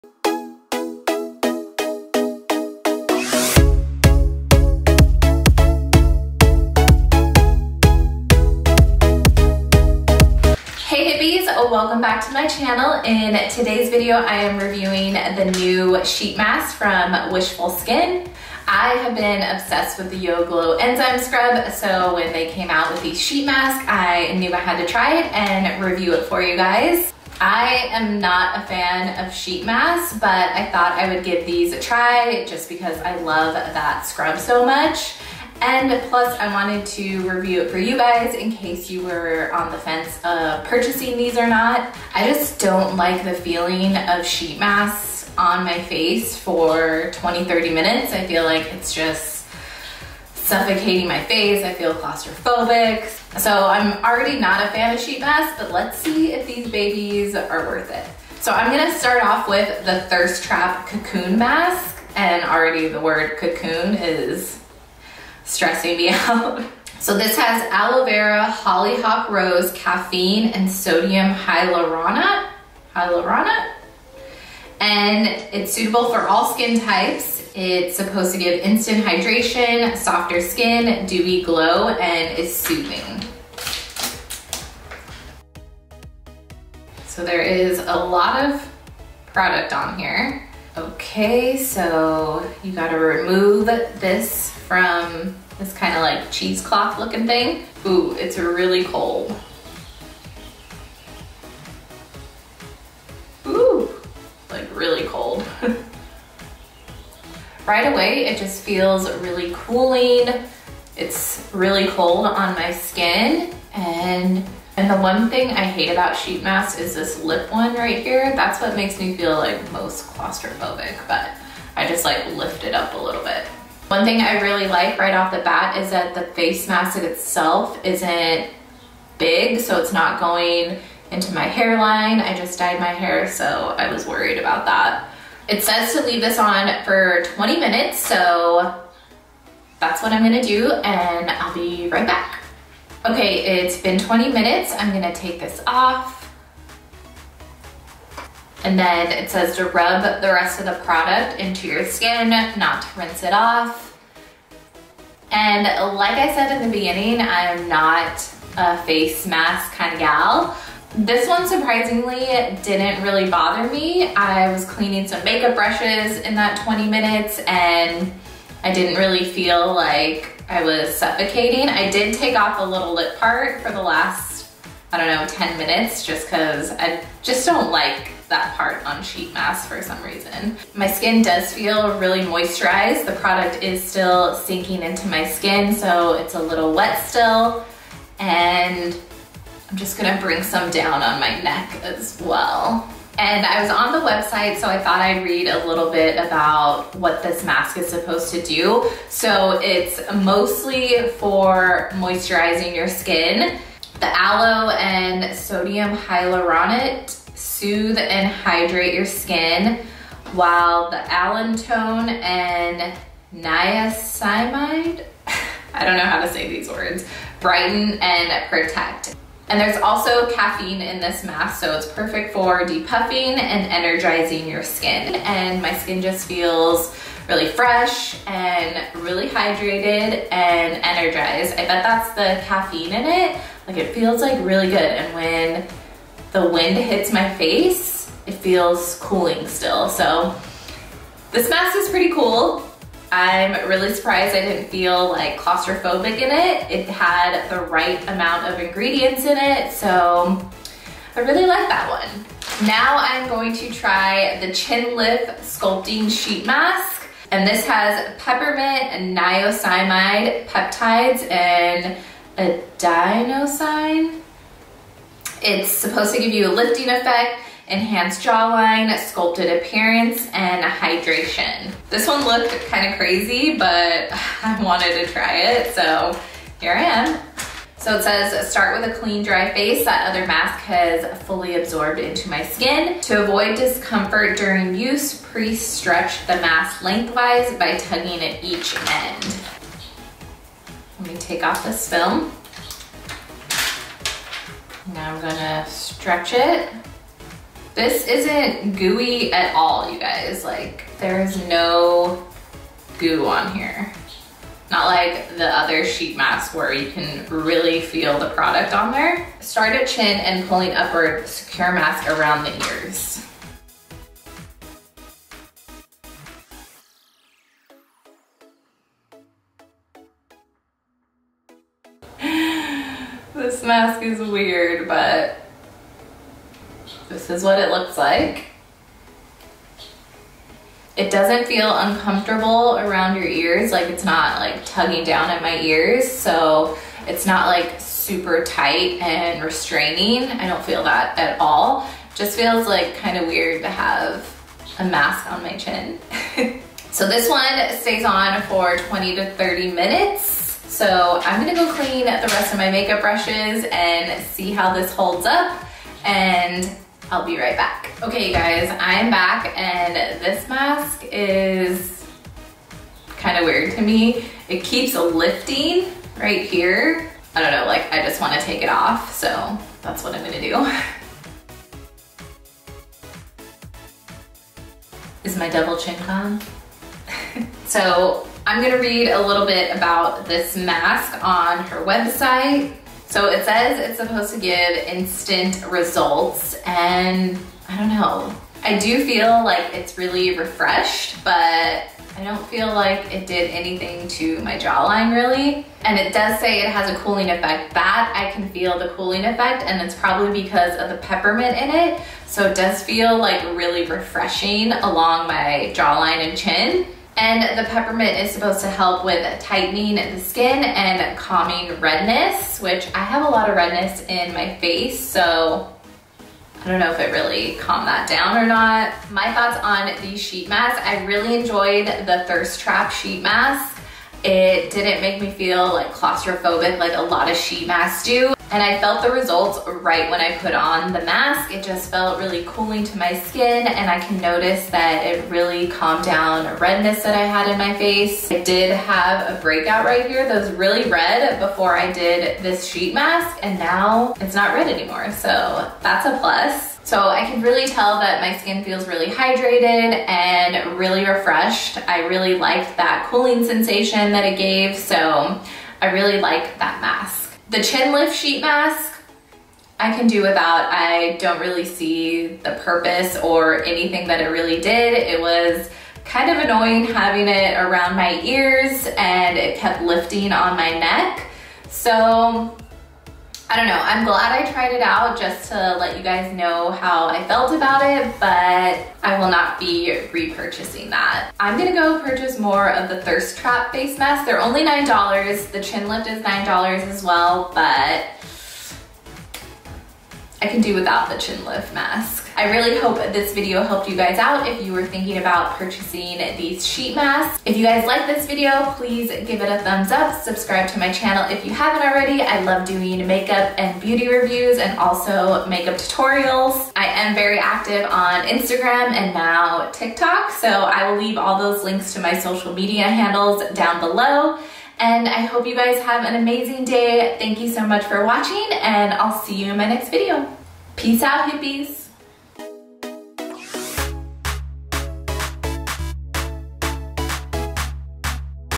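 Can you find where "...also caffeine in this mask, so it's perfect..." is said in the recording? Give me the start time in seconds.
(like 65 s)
219 s.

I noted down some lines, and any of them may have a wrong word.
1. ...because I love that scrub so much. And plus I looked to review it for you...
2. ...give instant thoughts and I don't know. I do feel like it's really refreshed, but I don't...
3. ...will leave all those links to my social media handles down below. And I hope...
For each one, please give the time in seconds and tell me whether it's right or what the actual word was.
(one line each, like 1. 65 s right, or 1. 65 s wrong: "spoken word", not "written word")
1. 32 s wrong: "wanted", not "looked"
2. 384 s wrong: "results", not "thoughts"
3. 510 s right.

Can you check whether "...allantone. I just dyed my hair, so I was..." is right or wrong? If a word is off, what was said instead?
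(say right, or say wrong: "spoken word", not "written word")
wrong: "hairline", not "allantone".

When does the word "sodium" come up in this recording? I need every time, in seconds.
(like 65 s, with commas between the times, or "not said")
70 s, 205 s.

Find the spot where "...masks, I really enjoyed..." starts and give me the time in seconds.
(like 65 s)
420 s.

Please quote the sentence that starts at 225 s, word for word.
And my skin just feels really fresh and really hydrated and energized.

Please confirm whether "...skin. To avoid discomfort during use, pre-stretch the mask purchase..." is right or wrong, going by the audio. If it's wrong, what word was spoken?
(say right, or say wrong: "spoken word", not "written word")
wrong: "lengthwise", not "purchase".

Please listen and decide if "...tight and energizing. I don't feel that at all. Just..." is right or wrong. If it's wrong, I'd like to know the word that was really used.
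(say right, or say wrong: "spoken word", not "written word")
wrong: "restraining", not "energizing".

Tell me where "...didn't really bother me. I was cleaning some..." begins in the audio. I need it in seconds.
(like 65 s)
162 s.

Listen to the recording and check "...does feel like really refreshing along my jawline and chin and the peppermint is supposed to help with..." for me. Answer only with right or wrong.
right.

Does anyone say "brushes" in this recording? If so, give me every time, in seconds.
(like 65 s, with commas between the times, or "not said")
165 s, 353 s.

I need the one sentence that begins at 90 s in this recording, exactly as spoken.
Okay, so you gotta remove this from this kind of like cheesecloth looking thing.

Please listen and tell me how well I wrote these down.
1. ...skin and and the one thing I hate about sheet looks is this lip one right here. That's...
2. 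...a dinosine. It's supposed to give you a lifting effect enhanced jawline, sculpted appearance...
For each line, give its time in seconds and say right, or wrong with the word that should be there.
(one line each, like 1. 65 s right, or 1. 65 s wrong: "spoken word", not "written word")
1. 112 s wrong: "masks", not "looks"
2. 262 s right.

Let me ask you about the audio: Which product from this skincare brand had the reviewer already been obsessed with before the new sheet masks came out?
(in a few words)
Yo Glow Enzyme Scrub.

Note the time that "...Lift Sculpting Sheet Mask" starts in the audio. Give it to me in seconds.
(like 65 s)
254 s.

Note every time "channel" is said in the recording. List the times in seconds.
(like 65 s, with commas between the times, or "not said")
12 s, 500 s.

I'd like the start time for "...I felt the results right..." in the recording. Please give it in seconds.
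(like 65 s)
428 s.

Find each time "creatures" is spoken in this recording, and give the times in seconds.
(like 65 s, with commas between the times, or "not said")
not said.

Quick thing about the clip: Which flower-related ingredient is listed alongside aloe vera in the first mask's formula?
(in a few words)
hollyhock rose.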